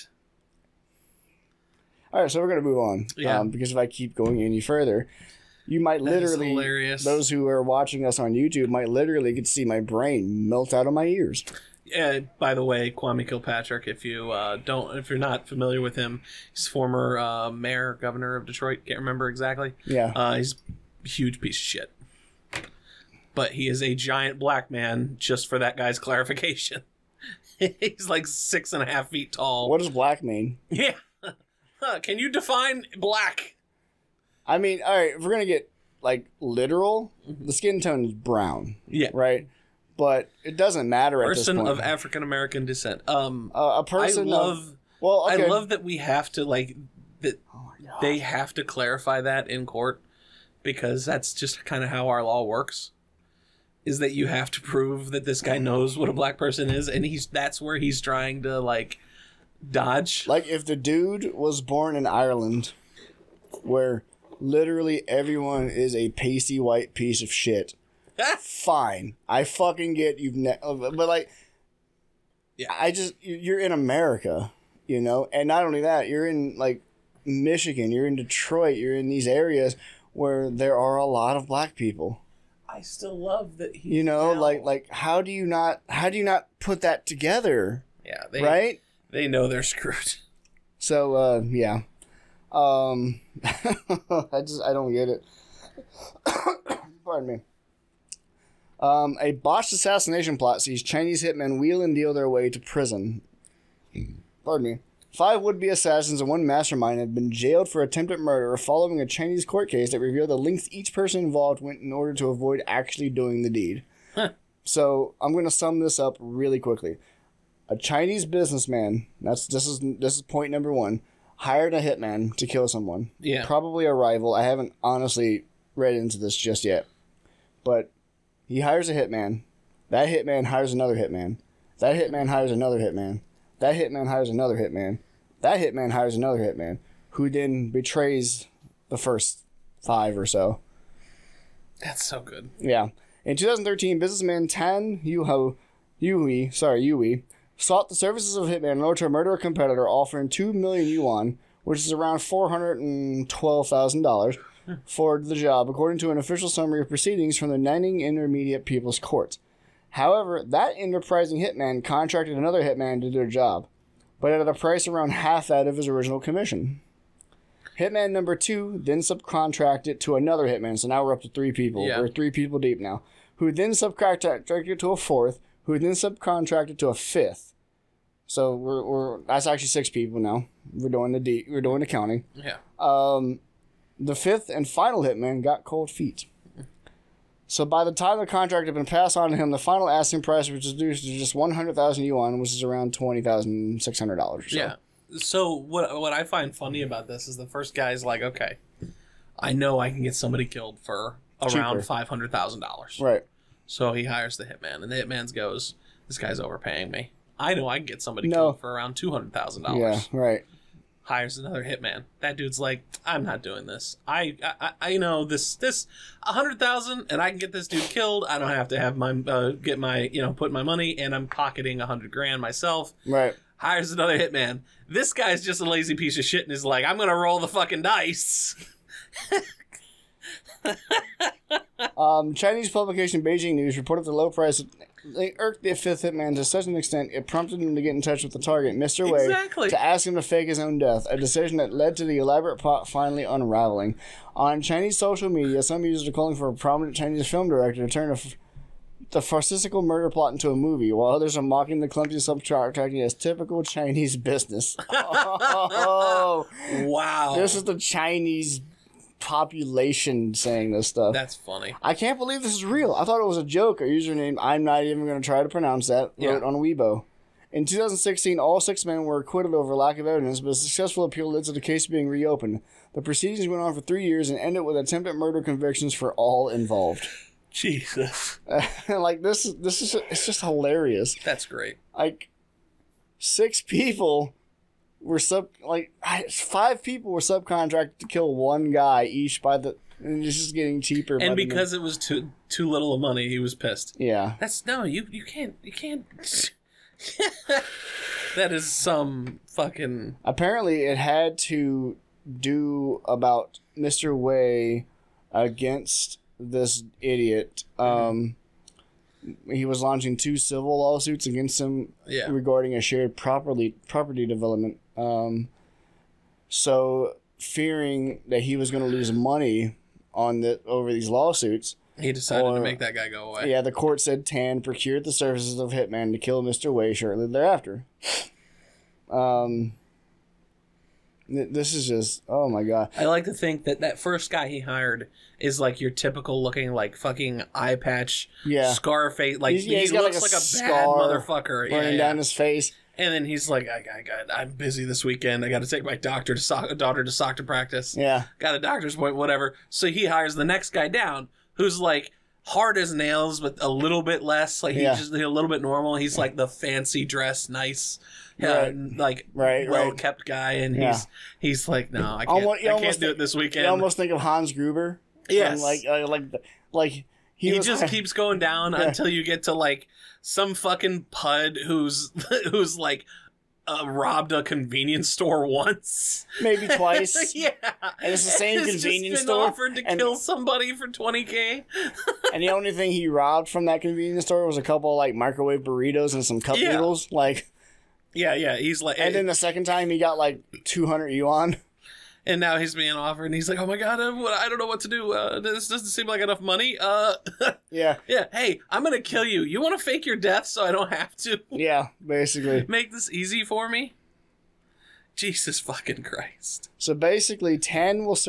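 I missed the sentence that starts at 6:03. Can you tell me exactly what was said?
You almost think of Hans Gruber.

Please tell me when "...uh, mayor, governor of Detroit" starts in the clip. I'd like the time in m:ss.
0:17.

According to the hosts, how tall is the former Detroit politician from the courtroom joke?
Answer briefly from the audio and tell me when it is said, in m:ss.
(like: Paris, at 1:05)
six and a half feet, at 0:28.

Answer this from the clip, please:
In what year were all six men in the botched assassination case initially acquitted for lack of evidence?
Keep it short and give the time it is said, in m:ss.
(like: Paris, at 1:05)
2016, at 4:27.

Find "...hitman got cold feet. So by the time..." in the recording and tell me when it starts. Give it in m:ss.
3:05.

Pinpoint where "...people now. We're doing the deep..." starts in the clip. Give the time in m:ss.
2:59.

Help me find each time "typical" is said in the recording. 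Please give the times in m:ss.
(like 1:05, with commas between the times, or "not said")
4:13, 5:35.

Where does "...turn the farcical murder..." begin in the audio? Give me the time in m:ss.
4:07.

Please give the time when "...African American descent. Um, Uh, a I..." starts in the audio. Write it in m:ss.
0:41.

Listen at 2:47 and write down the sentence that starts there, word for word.
Hitman number two then subcontracted to another hitman, so now we're up to three people.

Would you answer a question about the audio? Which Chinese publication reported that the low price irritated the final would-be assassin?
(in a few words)
Beijing News.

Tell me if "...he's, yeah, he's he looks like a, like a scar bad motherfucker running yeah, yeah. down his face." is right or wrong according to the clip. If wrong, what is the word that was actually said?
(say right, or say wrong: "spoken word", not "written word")
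right.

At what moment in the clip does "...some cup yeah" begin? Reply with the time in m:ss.
6:26.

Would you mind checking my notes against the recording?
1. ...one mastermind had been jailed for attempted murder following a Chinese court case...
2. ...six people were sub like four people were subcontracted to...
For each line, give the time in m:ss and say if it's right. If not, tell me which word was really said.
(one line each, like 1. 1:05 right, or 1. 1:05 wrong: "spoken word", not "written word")
1. 1:46 right
2. 4:43 wrong: "five", not "four".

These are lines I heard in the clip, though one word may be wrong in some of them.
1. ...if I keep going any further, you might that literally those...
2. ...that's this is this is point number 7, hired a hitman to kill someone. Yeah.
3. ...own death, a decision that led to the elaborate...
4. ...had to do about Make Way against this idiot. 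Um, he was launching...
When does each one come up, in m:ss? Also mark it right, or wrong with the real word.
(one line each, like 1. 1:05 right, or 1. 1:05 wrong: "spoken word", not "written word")
1. 0:03 right
2. 1:59 wrong: "1", not "7"
3. 4:00 right
4. 5:00 wrong: "Mister", not "Make".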